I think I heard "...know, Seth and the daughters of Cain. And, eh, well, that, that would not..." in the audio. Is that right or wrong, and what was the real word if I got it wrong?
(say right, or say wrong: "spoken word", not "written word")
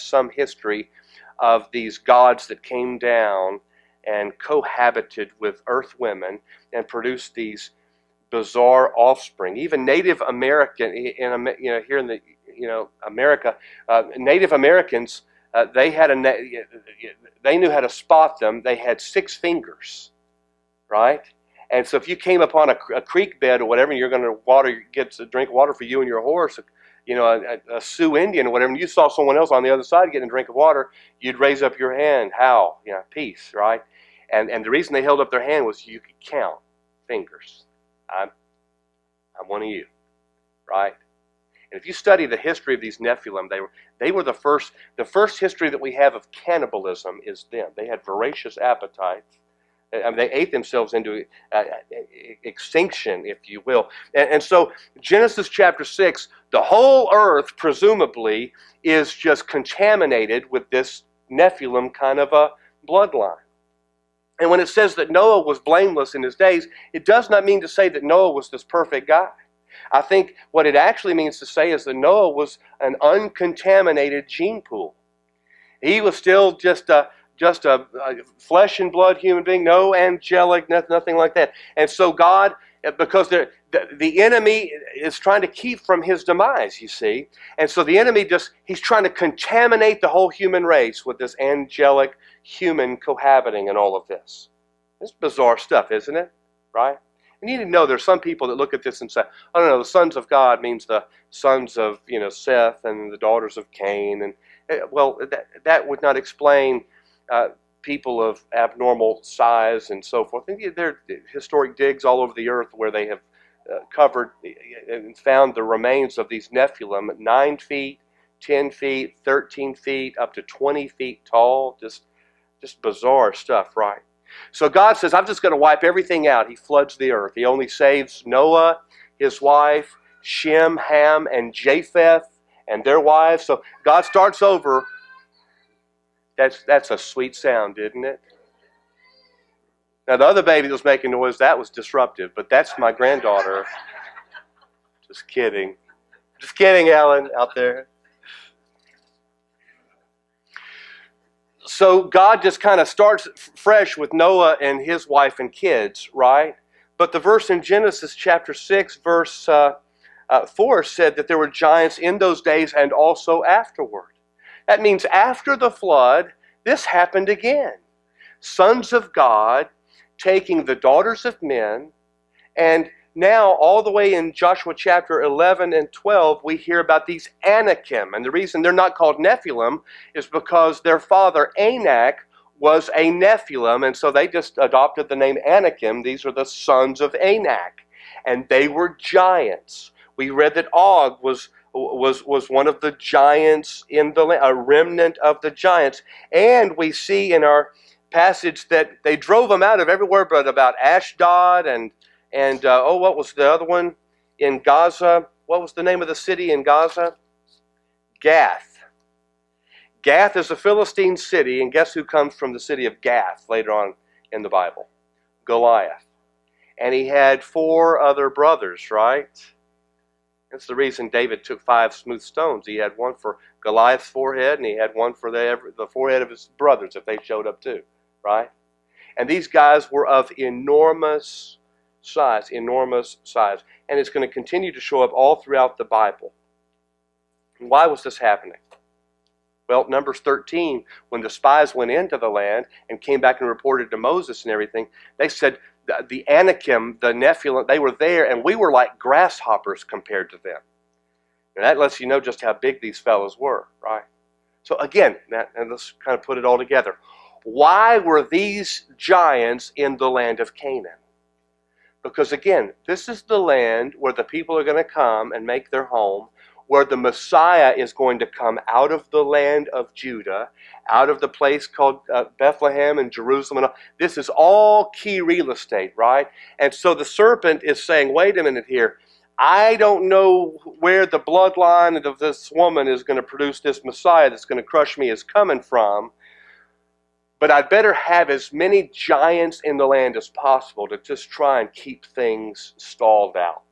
right.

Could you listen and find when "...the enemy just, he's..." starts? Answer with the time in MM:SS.
01:27.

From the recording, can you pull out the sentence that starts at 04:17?
Why were these giants in the land of Canaan?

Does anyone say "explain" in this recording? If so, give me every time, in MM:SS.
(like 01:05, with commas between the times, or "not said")
01:46.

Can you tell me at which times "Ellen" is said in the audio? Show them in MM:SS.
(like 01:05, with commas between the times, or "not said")
02:26.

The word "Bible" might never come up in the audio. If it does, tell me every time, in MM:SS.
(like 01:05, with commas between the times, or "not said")
03:34, 03:55.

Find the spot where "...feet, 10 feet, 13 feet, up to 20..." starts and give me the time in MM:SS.
01:57.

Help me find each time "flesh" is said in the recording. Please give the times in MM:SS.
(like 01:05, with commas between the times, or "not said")
01:18.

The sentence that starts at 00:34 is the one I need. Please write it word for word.
And and the reason they held up their hand was you could count fingers.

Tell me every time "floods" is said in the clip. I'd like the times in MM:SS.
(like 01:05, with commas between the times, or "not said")
02:06, 02:45.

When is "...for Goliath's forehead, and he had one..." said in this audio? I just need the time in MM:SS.
03:43.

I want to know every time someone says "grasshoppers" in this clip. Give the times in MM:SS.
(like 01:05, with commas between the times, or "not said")
04:08.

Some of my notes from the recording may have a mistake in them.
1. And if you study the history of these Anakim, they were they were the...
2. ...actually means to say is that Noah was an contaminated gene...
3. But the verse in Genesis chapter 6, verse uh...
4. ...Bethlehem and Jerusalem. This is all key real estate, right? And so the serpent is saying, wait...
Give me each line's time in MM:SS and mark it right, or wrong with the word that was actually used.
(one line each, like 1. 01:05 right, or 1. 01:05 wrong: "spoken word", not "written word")
1. 00:41 wrong: "Nephilim", not "Anakim"
2. 01:10 wrong: "uncontaminated", not "contaminated"
3. 02:36 right
4. 04:32 right.